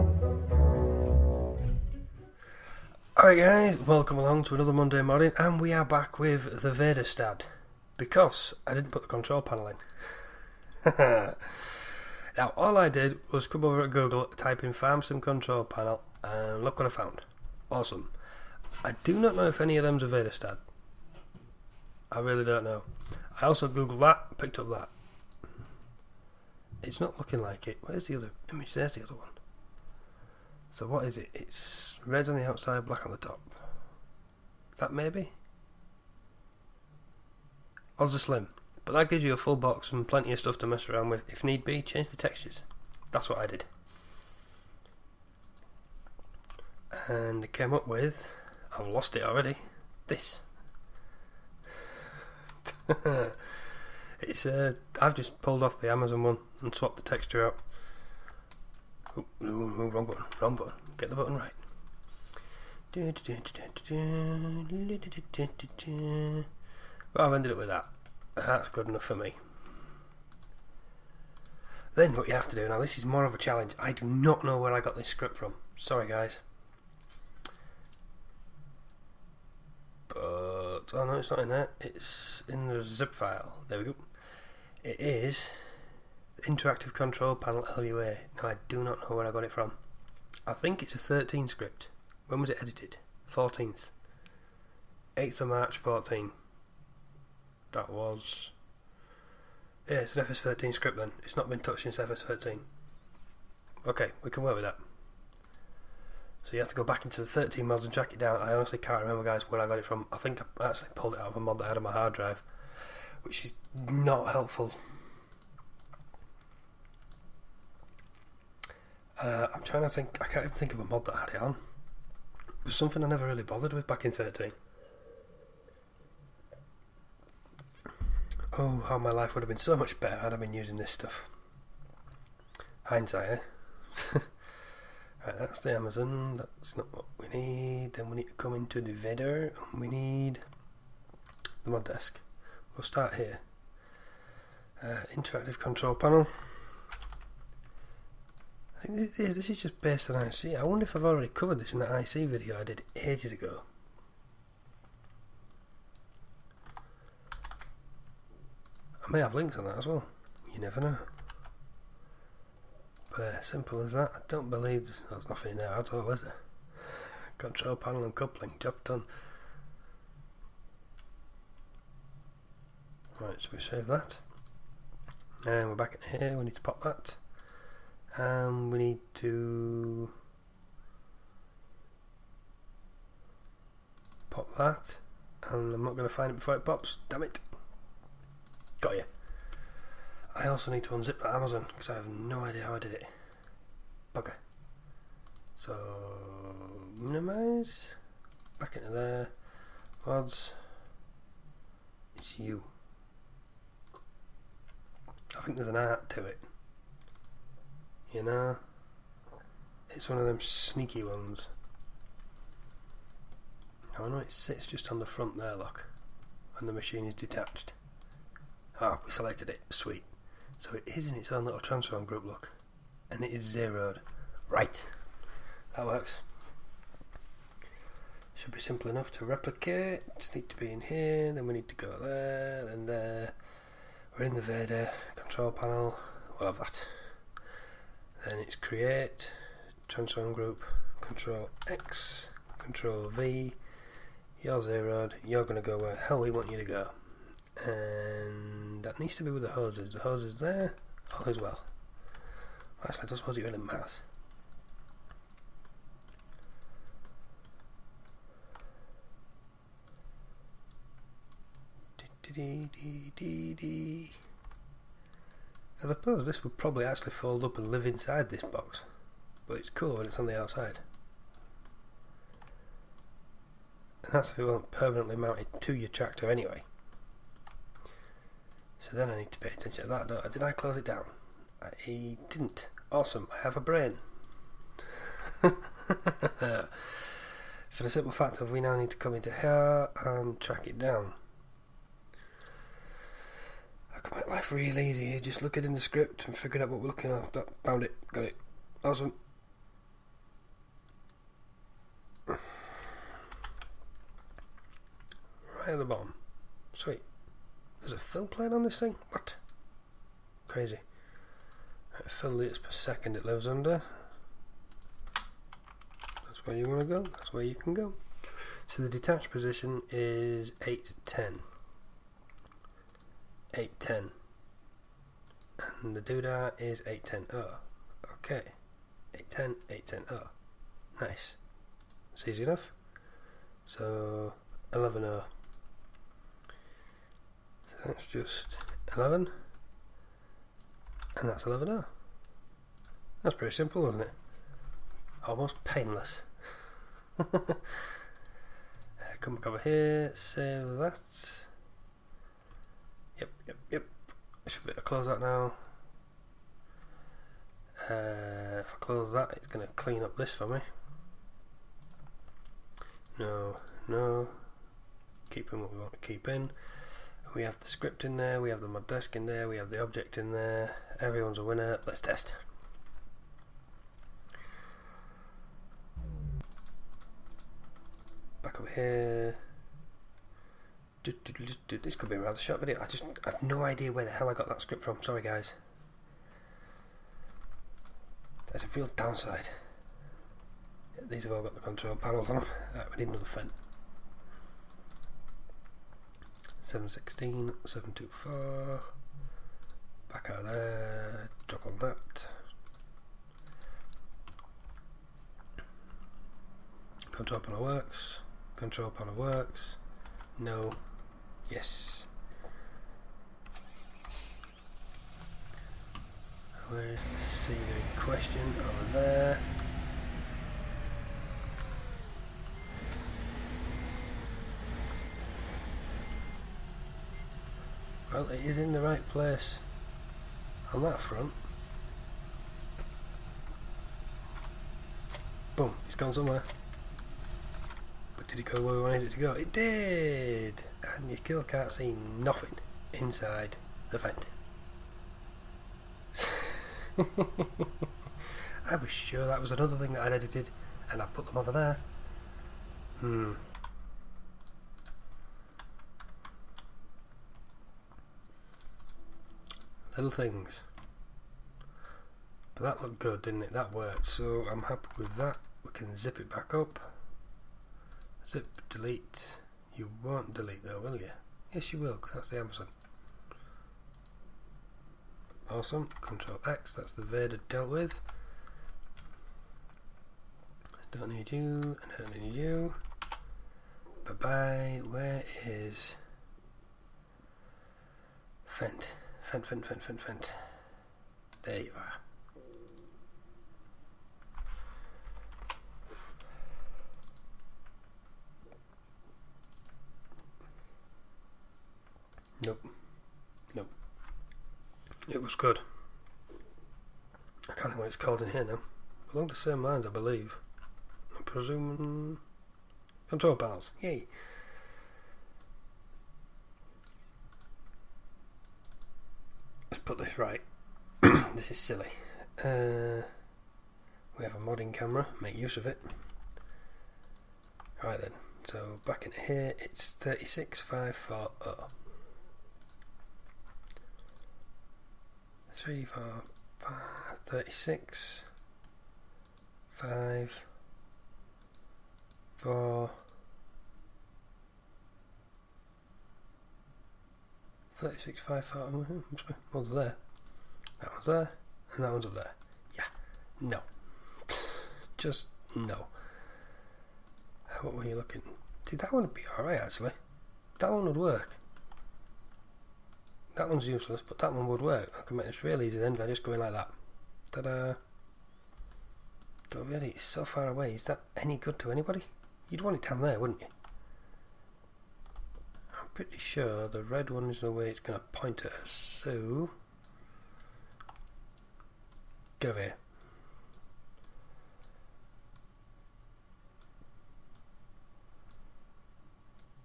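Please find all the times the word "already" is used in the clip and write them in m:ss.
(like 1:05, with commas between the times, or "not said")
0:49, 2:31.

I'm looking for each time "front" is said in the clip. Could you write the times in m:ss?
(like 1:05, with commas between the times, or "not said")
3:35, 7:10.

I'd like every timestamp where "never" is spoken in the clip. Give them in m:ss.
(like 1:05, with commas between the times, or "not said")
2:03, 2:40.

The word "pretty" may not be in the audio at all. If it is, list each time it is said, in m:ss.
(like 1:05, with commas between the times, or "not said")
5:43, 9:36.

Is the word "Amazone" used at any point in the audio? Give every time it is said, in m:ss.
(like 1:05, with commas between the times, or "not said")
0:55, 2:15, 3:11, 7:52.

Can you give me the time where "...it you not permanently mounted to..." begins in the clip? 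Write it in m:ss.
4:34.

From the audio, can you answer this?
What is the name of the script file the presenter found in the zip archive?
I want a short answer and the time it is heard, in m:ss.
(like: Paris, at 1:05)
interactive control panel LUA, at 1:26.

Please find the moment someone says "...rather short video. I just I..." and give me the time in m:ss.
6:22.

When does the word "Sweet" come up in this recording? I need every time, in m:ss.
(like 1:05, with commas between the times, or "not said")
3:39, 5:06.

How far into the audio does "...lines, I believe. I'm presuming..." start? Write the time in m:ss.
8:29.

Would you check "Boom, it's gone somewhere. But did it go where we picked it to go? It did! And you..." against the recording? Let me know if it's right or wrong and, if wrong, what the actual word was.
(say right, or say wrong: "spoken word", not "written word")
wrong: "wanted", not "picked".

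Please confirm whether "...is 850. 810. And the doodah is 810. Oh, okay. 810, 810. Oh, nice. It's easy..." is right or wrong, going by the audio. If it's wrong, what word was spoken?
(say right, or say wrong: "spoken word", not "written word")
wrong: "810", not "850".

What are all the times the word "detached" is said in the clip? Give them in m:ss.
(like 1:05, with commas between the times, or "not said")
3:37, 5:18.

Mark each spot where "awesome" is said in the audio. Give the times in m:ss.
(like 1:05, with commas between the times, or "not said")
0:17, 4:42, 4:58, 7:55.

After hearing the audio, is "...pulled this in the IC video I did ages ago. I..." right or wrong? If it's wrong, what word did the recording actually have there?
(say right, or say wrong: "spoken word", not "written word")
wrong: "covered", not "pulled".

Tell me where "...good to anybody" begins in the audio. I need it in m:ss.
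9:31.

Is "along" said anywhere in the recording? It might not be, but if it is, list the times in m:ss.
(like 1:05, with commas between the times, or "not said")
0:04, 8:29.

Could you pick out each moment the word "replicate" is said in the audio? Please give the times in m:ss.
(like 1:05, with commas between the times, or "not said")
3:49.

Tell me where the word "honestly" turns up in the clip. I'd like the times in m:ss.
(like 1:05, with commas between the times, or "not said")
1:48.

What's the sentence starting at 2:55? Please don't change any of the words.
And we're back in here, we need to pop that.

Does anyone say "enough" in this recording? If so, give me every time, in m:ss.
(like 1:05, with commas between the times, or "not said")
1:08, 3:48, 5:32.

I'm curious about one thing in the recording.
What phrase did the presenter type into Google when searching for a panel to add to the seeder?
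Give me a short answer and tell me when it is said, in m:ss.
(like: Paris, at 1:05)
farm sim control panel, at 0:14.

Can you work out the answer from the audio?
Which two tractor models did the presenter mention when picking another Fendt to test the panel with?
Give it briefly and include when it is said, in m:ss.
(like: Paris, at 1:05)
716, 724, at 6:36.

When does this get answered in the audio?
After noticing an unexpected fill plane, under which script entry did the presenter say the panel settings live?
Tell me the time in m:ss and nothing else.
5:12.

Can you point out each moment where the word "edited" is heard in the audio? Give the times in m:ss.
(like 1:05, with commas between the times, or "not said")
1:32, 7:30.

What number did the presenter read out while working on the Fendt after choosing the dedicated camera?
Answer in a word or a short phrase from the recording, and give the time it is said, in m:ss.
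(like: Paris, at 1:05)
36540, at 8:49.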